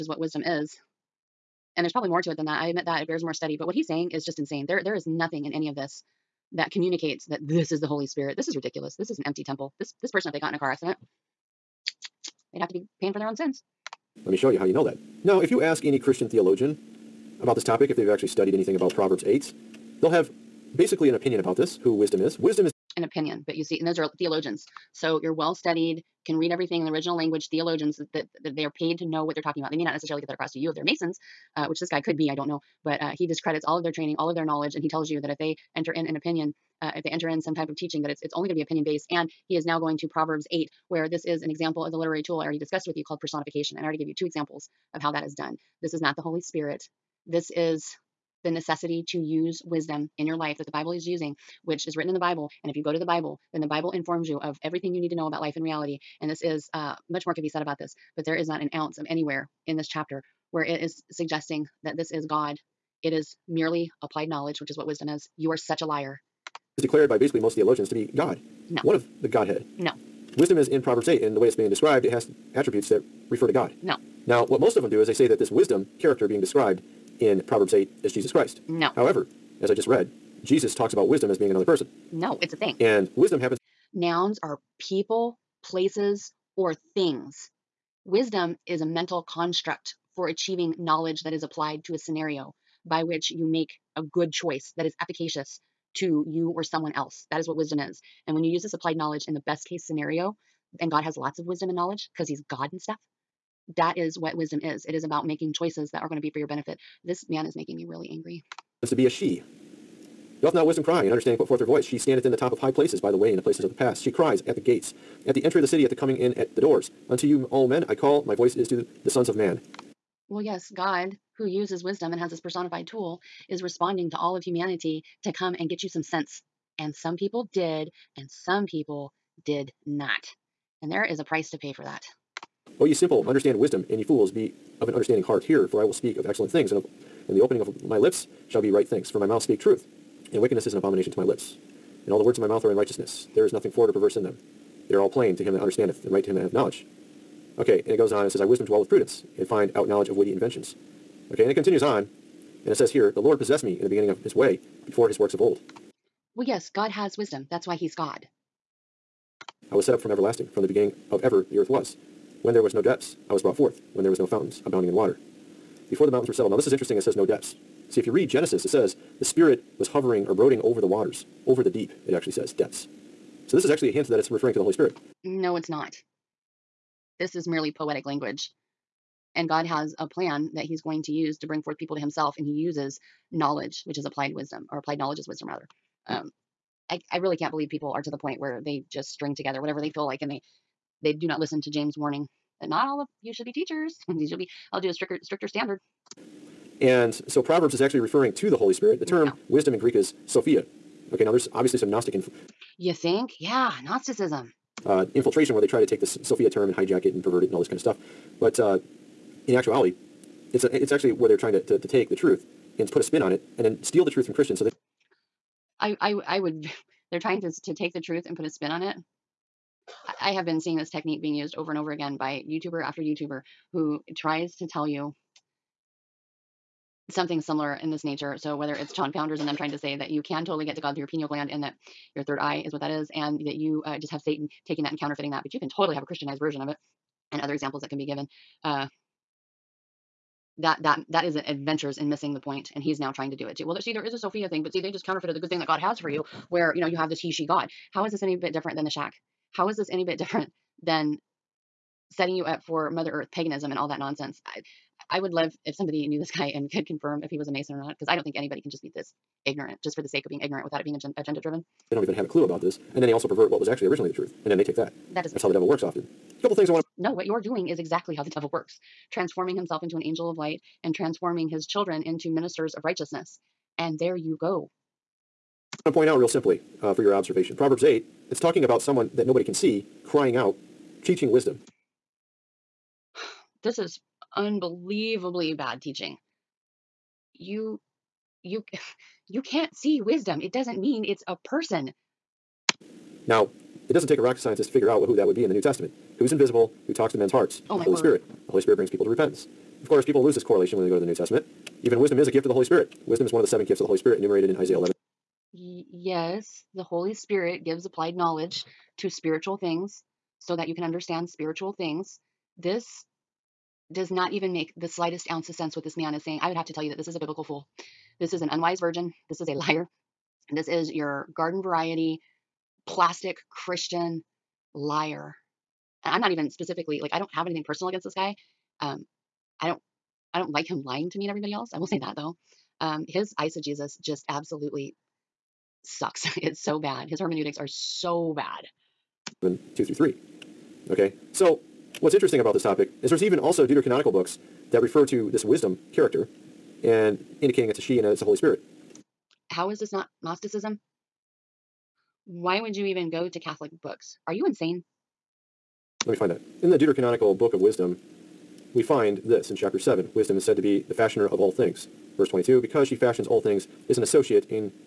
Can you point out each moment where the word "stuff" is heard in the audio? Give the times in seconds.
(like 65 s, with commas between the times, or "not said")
102 s, 207 s.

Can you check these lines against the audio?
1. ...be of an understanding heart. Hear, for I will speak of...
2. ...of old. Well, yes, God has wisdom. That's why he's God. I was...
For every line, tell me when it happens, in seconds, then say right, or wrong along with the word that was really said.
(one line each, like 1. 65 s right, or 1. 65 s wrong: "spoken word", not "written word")
1. 134 s right
2. 155 s right.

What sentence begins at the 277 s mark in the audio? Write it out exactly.
Proverbs 8 it's talking about someone that nobody can see crying out, teaching wisdom.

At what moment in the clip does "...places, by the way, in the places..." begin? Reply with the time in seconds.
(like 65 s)
112 s.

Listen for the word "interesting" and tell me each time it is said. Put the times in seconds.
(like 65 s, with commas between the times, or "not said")
166 s, 342 s.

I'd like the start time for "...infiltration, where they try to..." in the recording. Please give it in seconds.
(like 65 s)
205 s.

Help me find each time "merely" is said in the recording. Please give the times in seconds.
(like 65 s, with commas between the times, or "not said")
63 s, 177 s.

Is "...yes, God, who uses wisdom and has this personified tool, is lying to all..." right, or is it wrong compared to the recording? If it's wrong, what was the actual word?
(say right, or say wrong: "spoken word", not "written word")
wrong: "responding", not "lying".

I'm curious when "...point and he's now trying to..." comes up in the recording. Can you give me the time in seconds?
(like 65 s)
242 s.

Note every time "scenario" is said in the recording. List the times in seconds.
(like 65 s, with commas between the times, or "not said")
91 s, 99 s.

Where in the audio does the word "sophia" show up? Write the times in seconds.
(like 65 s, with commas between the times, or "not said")
200 s, 206 s, 244 s.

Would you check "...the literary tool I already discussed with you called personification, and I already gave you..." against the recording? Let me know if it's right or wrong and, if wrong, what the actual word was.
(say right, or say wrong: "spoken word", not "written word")
right.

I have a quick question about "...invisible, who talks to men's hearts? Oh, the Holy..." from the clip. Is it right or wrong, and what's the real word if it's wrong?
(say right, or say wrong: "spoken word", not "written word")
right.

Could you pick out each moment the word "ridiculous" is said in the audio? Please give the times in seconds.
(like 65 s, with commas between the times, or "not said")
8 s.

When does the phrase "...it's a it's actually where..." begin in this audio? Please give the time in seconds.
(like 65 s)
210 s.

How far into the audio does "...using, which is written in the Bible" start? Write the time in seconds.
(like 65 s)
51 s.